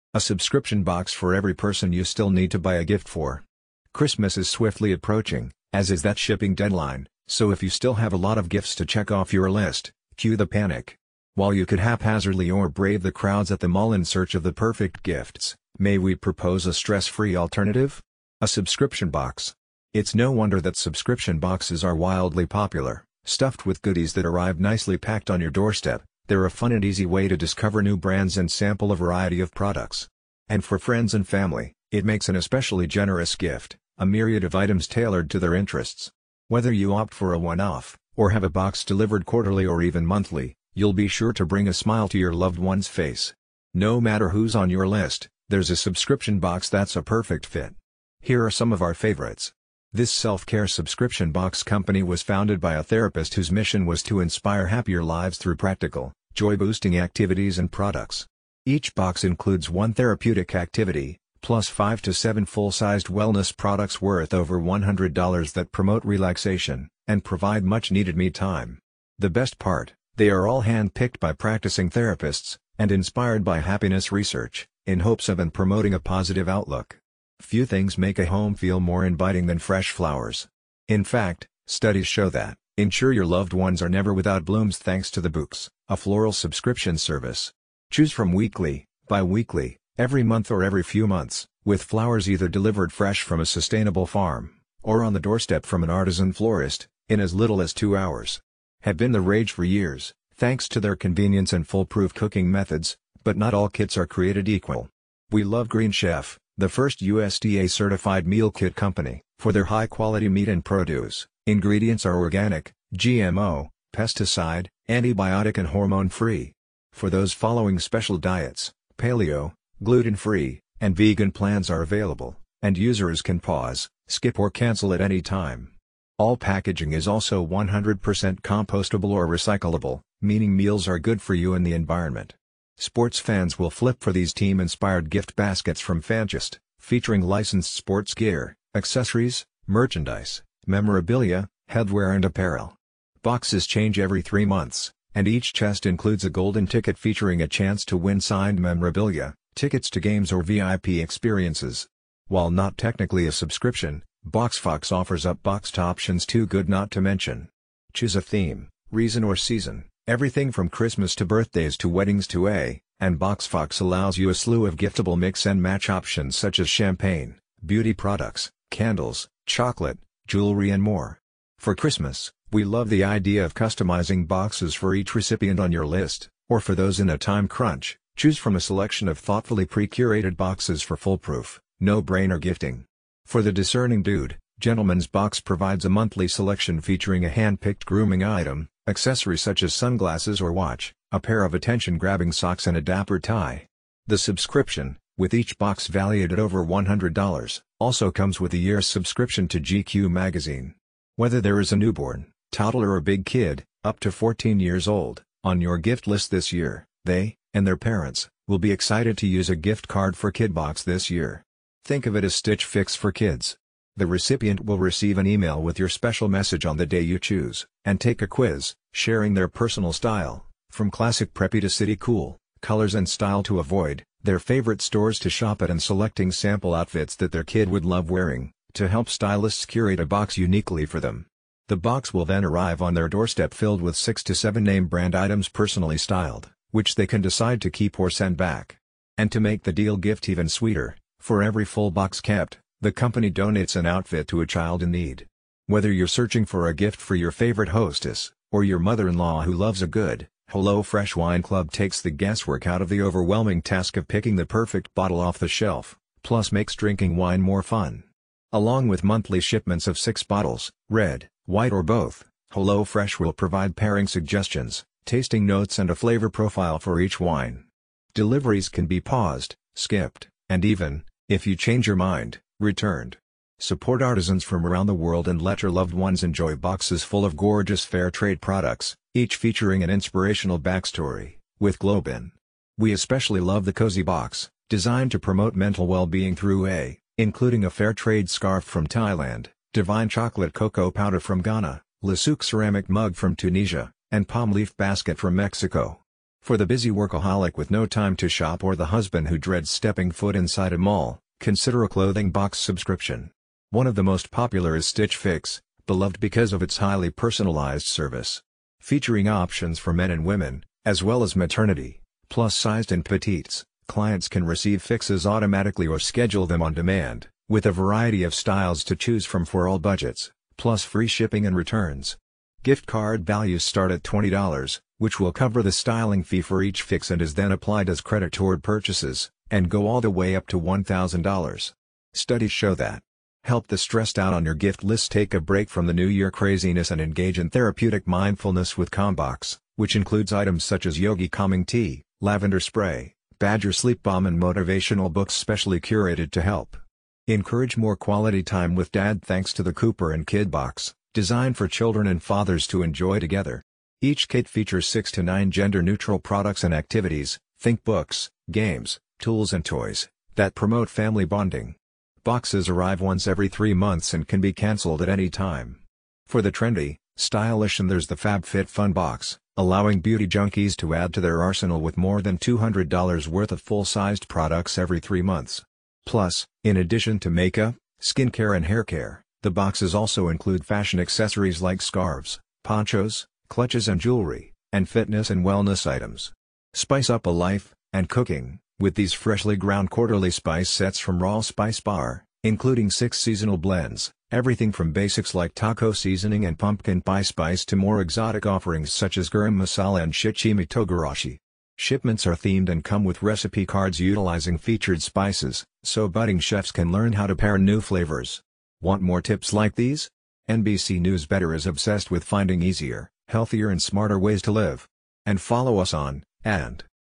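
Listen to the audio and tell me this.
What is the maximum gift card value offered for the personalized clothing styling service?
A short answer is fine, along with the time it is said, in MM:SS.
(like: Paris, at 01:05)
$1,000, at 05:30.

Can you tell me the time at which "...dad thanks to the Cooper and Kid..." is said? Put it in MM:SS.
05:48.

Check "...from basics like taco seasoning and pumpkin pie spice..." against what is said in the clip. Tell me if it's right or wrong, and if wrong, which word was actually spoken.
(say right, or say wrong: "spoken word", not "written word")
right.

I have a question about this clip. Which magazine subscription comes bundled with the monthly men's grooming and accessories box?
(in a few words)
GQ.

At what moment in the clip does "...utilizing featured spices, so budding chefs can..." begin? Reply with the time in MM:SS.
06:43.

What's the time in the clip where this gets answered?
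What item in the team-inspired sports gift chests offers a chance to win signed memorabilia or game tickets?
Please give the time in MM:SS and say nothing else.
02:26.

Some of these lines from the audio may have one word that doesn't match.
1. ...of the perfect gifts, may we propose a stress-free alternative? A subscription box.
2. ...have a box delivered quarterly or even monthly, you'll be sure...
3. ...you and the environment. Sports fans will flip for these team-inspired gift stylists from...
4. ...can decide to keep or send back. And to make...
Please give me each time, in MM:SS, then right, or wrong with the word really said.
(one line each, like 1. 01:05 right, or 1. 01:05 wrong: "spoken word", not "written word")
1. 00:14 right
2. 00:38 right
3. 02:11 wrong: "baskets", not "stylists"
4. 03:57 right.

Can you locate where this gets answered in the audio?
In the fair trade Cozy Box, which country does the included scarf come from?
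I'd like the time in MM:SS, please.
04:48.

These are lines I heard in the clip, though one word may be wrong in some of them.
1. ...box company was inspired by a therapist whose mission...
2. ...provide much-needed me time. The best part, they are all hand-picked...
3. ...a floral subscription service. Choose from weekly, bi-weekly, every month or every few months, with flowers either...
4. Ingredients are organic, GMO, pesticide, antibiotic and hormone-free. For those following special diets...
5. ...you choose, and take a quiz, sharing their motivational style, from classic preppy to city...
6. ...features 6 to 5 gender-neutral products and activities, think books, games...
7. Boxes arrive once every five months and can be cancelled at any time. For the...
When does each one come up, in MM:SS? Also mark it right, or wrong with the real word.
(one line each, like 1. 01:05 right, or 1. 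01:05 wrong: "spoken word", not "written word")
1. 00:51 wrong: "founded", not "inspired"
2. 01:07 right
3. 01:25 right
4. 01:51 right
5. 03:37 wrong: "personal", not "motivational"
6. 05:54 wrong: "9", not "5"
7. 06:02 wrong: "three", not "five".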